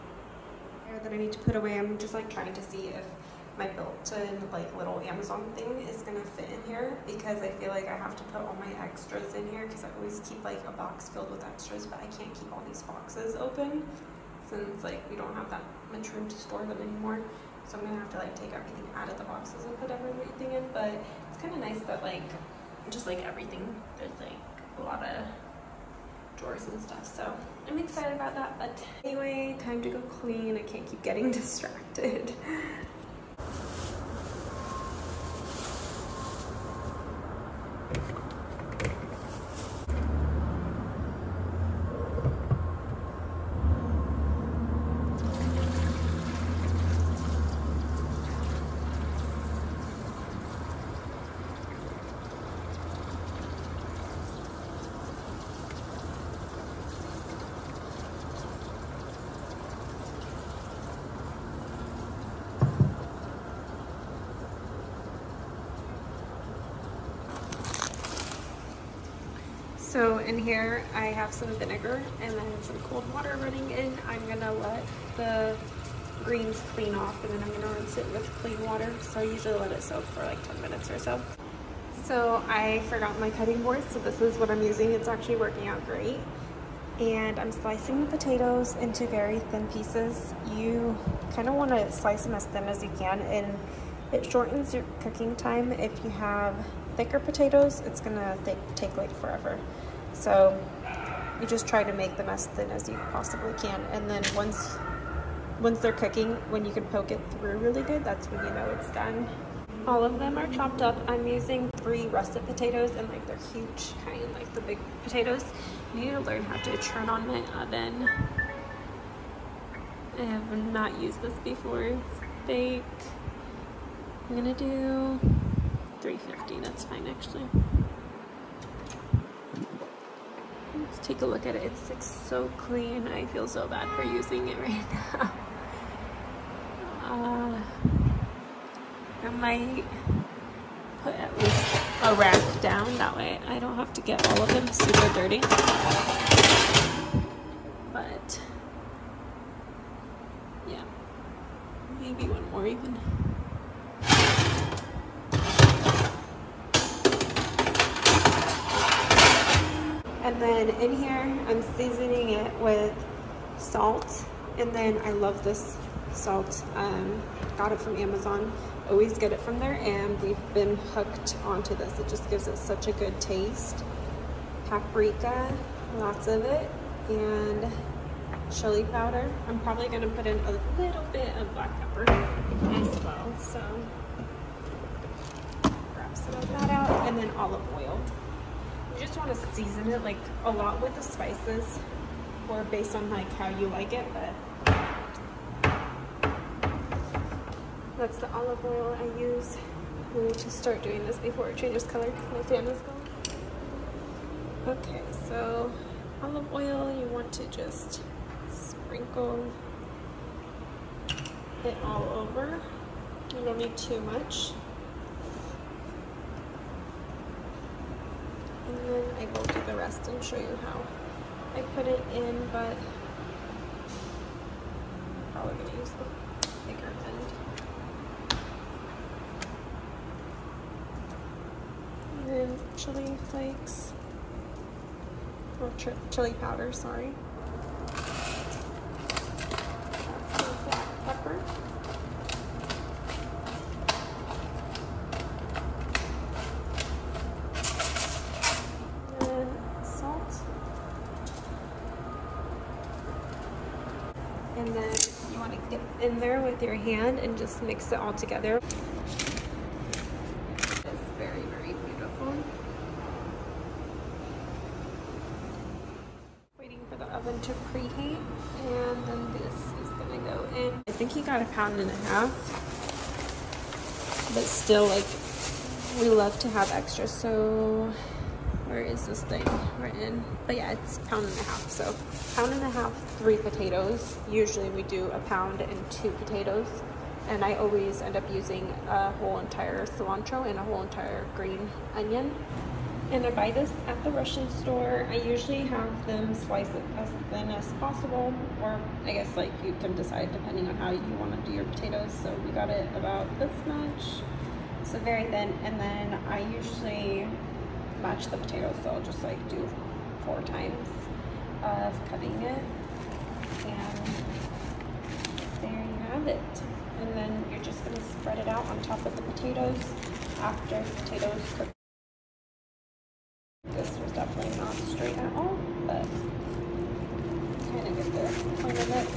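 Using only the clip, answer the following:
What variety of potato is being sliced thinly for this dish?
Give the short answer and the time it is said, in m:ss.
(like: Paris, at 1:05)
Russet, at 1:52.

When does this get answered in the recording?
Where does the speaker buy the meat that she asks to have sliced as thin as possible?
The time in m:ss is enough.
4:54.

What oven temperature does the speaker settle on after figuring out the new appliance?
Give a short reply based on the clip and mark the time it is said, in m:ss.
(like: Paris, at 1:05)
350, at 2:06.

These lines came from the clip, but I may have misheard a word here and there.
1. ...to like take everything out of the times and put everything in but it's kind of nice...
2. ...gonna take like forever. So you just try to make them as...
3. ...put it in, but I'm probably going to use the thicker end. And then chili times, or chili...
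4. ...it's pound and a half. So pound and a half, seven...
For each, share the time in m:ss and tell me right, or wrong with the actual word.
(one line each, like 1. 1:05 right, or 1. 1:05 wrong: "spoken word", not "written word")
1. 0:18 wrong: "boxes", not "times"
2. 1:38 right
3. 3:41 wrong: "flakes", not "times"
4. 4:40 wrong: "three", not "seven".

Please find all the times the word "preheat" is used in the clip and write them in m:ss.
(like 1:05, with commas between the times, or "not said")
4:27.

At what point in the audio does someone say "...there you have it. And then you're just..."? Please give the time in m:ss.
5:15.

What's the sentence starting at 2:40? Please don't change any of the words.
And then in here, I'm seasoning it with salt.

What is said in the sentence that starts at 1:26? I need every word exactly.
And I'm slicing the potatoes into very thin pieces.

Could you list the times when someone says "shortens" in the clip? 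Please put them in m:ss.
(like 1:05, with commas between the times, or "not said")
1:34.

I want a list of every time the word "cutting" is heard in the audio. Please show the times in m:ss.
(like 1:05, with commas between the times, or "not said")
1:23, 5:12.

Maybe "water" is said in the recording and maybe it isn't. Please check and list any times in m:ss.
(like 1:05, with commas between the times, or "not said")
1:13, 1:18.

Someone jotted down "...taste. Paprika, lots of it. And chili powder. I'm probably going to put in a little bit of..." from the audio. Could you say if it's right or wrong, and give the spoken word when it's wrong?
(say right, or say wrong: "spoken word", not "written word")
right.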